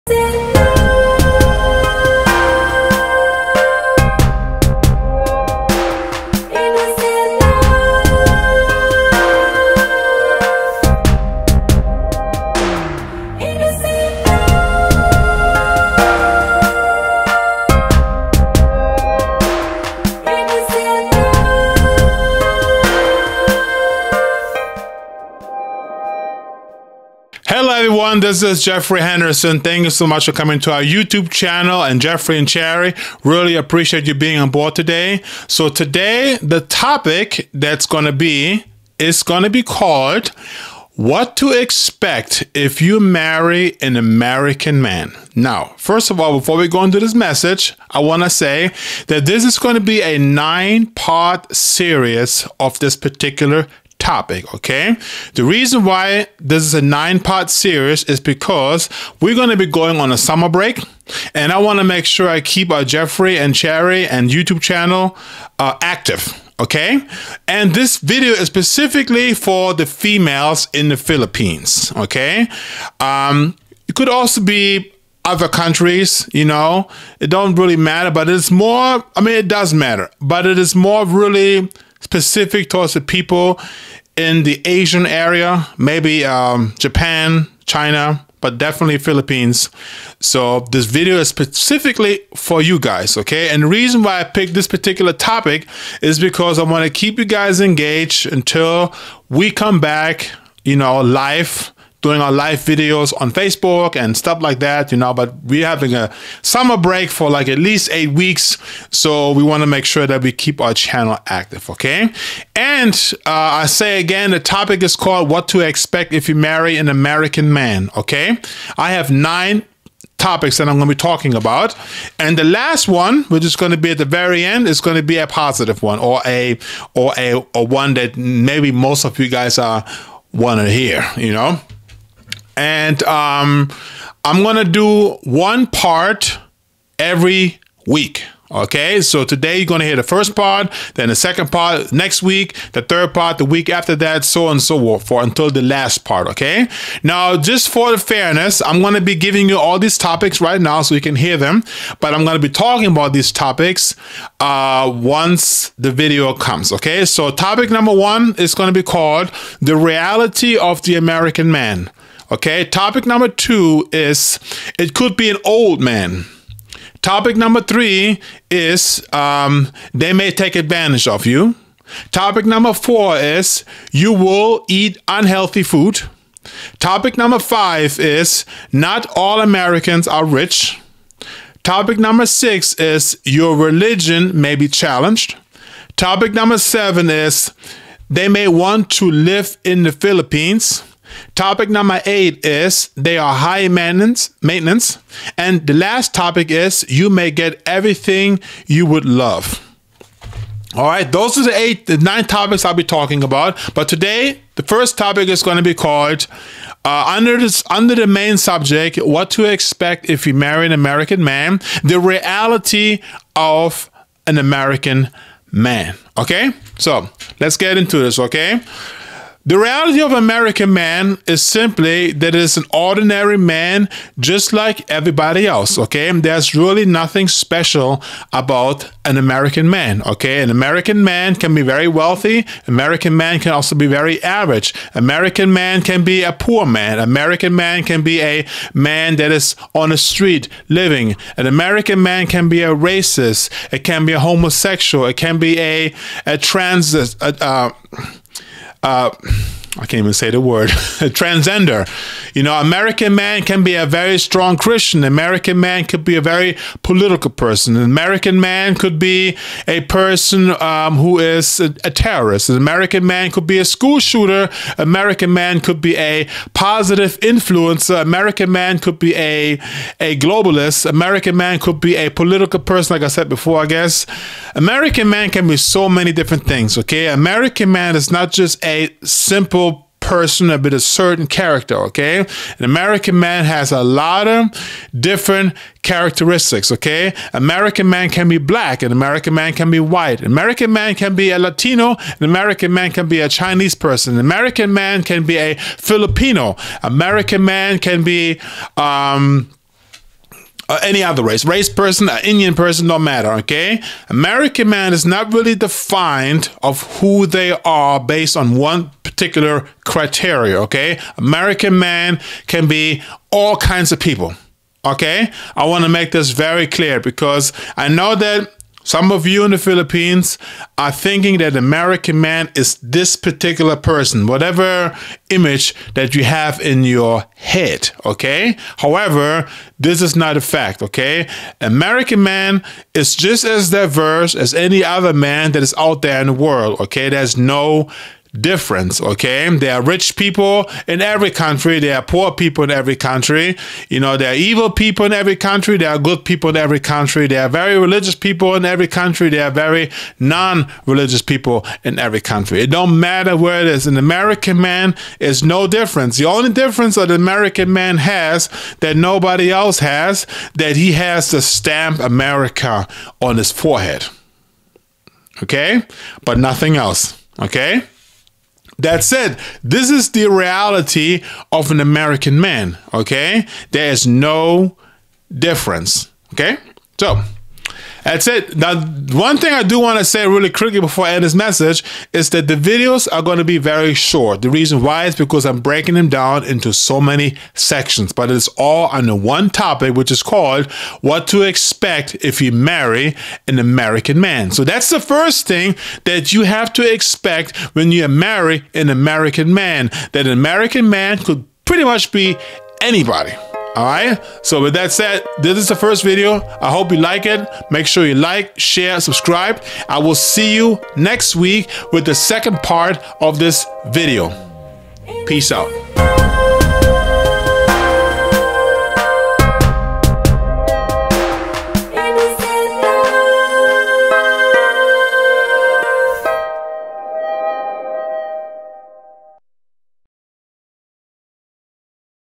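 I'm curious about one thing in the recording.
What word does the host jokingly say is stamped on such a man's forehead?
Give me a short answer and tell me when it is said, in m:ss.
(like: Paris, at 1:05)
America, at 6:01.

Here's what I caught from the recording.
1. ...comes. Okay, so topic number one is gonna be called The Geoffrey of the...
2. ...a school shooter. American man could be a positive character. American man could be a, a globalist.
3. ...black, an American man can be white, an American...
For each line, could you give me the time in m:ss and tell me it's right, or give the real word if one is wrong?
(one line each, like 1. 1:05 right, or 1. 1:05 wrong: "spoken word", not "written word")
1. 2:36 wrong: "Reality", not "Geoffrey"
2. 4:23 wrong: "influencer", not "character"
3. 4:48 right.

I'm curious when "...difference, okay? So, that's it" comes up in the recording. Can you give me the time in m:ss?
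6:15.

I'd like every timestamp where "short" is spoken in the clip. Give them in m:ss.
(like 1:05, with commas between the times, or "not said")
6:23.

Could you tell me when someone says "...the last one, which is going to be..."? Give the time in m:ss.
2:02.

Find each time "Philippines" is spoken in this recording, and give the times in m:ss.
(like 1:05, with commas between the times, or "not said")
1:10, 1:28, 3:09, 5:19.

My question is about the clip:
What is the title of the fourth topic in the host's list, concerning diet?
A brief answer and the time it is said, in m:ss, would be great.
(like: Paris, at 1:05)
You will eat unhealthy food, at 2:53.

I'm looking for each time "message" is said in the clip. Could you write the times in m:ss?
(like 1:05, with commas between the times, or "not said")
0:47, 6:21.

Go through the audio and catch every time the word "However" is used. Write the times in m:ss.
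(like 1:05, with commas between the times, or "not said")
5:28.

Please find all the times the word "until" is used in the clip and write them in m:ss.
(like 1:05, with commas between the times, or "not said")
1:38, 2:25.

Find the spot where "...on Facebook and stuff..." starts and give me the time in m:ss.
1:43.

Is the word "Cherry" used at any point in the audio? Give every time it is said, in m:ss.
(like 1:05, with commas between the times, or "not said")
0:32, 1:03.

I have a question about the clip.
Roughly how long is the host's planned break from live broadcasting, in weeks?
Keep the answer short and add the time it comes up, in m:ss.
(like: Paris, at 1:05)
8 weeks, at 1:47.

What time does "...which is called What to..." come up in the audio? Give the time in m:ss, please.
6:29.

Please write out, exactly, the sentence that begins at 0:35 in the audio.
So today the topic that's going to be is going to be called what to expect if you marry an American man.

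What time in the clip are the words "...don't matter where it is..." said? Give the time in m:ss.
5:52.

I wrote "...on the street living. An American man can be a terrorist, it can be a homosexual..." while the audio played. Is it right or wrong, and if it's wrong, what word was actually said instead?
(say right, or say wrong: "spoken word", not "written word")
wrong: "racist", not "terrorist".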